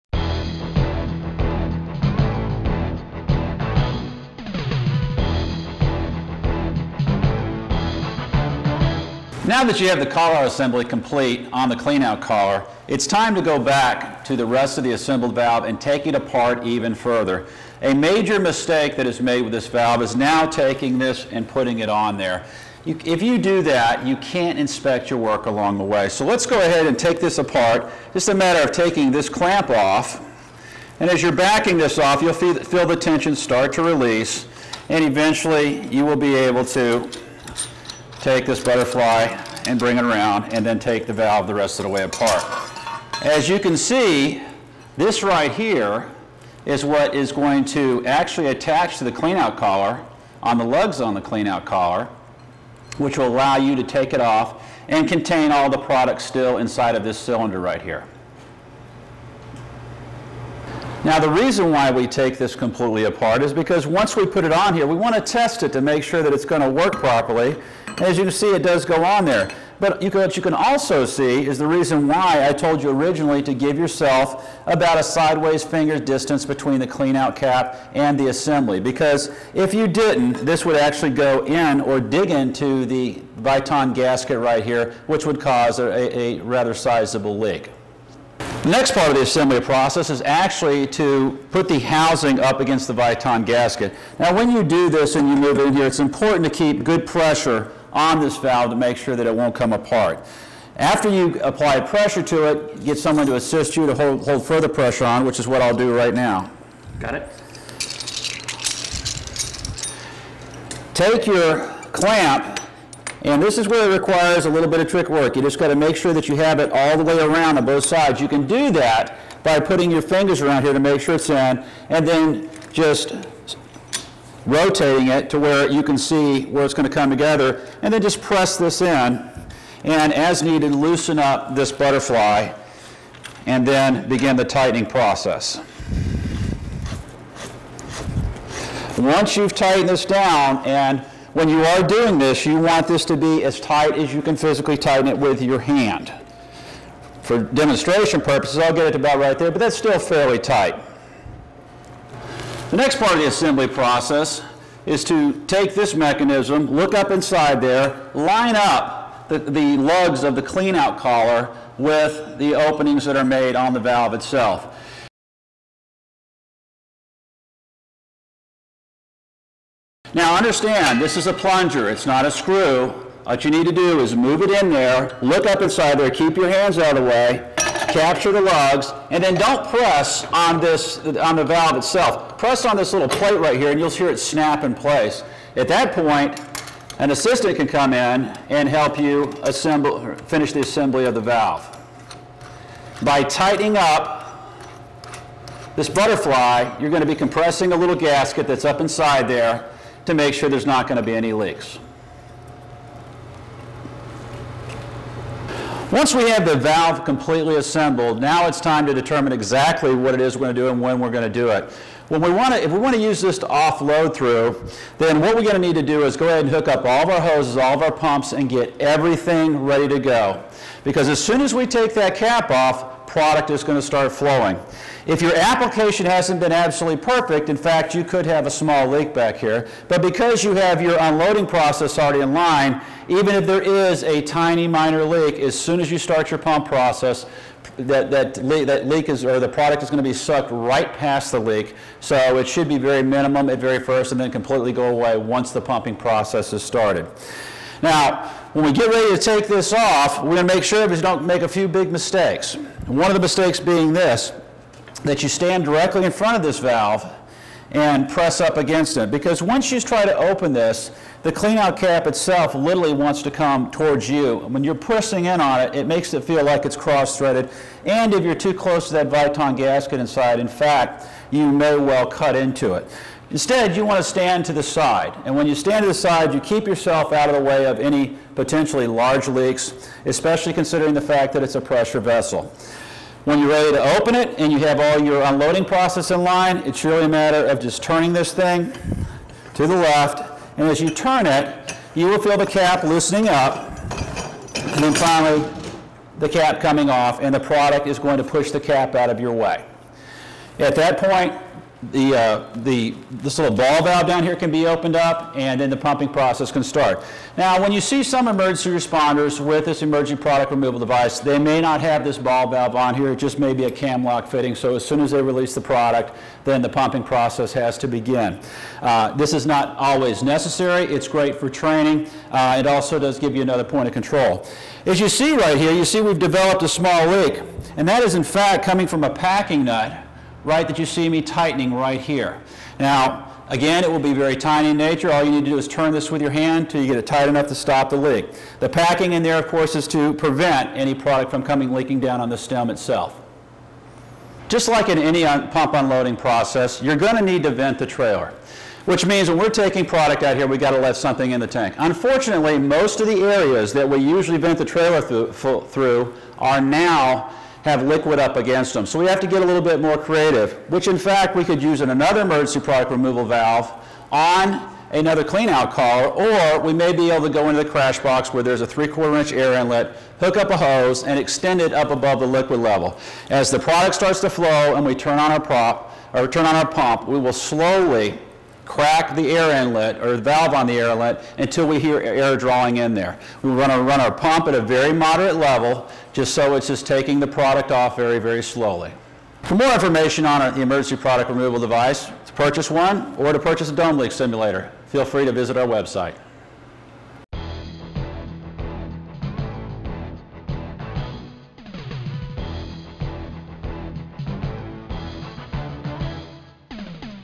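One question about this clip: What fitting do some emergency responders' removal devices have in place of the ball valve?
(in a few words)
Cam lock fitting.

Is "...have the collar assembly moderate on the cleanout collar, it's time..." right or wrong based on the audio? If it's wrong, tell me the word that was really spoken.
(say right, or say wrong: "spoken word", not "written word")
wrong: "complete", not "moderate".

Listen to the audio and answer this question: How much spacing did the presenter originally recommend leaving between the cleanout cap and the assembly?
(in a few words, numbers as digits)
A sideways finger.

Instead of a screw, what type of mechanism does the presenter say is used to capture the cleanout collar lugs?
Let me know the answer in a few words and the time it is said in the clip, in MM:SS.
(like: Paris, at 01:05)
A plunger, at 02:51.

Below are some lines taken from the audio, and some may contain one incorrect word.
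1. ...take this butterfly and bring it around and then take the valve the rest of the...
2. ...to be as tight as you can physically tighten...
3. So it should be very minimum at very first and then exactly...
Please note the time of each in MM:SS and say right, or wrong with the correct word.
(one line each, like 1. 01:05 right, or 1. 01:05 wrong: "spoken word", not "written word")
1. 00:38 right
2. 02:23 right
3. 04:01 wrong: "completely", not "exactly".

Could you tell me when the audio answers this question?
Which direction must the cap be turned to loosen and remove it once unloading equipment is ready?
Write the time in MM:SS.
04:47.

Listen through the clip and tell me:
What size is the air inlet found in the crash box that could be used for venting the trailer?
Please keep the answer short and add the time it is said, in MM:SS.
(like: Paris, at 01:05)
3/4 inch, at 06:08.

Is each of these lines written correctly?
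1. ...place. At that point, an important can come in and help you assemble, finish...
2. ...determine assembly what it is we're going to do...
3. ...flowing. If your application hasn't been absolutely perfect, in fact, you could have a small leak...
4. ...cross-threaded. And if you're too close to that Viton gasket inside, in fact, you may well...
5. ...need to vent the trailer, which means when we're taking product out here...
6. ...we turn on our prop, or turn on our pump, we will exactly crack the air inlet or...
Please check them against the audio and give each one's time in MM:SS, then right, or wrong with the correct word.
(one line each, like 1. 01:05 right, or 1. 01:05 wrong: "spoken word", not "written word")
1. 03:04 wrong: "assistant", not "important"
2. 03:28 wrong: "exactly", not "assembly"
3. 03:44 right
4. 04:26 right
5. 05:47 right
6. 06:14 wrong: "slowly", not "exactly".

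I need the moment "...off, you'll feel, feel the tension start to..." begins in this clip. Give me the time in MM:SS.
00:31.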